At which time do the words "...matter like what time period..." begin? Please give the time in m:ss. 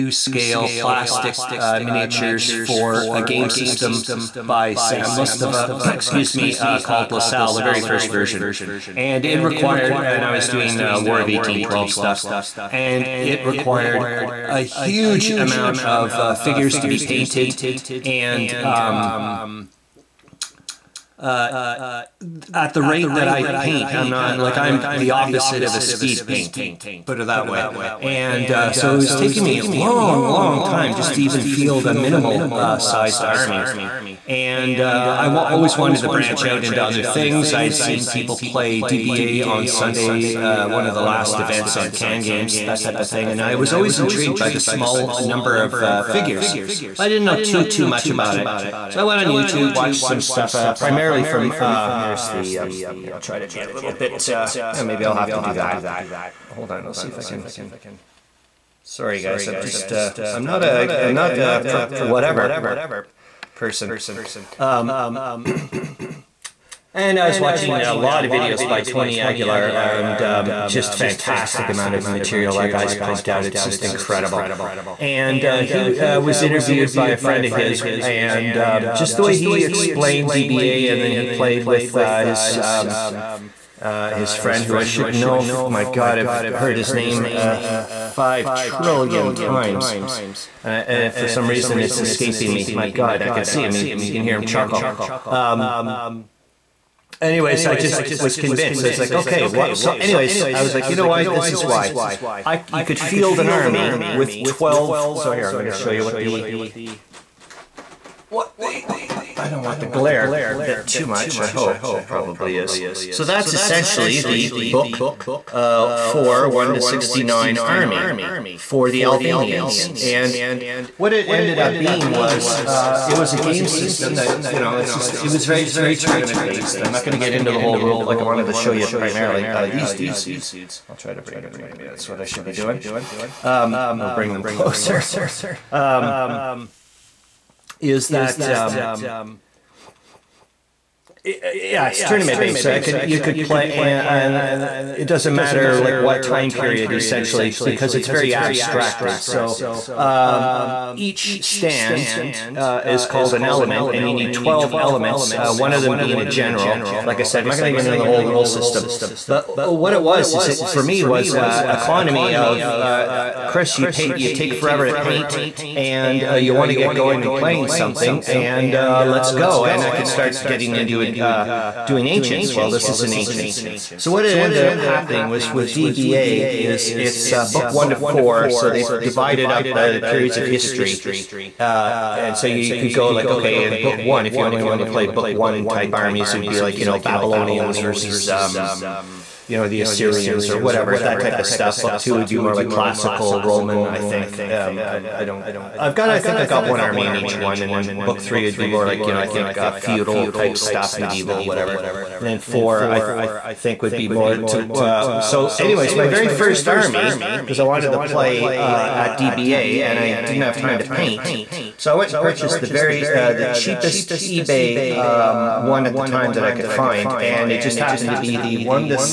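2:25.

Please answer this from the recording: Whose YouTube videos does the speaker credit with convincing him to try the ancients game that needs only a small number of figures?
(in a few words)
Tony Aguilar.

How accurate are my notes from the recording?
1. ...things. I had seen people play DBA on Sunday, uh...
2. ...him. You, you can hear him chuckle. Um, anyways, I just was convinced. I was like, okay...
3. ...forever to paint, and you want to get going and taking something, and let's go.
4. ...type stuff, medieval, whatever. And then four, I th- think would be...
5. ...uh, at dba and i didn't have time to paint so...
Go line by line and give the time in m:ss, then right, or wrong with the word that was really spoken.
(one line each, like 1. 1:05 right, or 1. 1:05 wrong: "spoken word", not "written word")
1. 0:37 right
2. 1:33 right
3. 2:44 wrong: "playing", not "taking"
4. 3:20 right
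5. 3:28 right.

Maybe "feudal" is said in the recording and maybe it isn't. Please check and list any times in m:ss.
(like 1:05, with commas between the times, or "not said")
3:19.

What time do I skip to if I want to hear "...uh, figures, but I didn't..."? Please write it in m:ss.
0:45.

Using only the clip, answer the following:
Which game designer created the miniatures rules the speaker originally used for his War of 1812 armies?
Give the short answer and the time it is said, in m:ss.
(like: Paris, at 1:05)
Sam Mustafa, at 0:04.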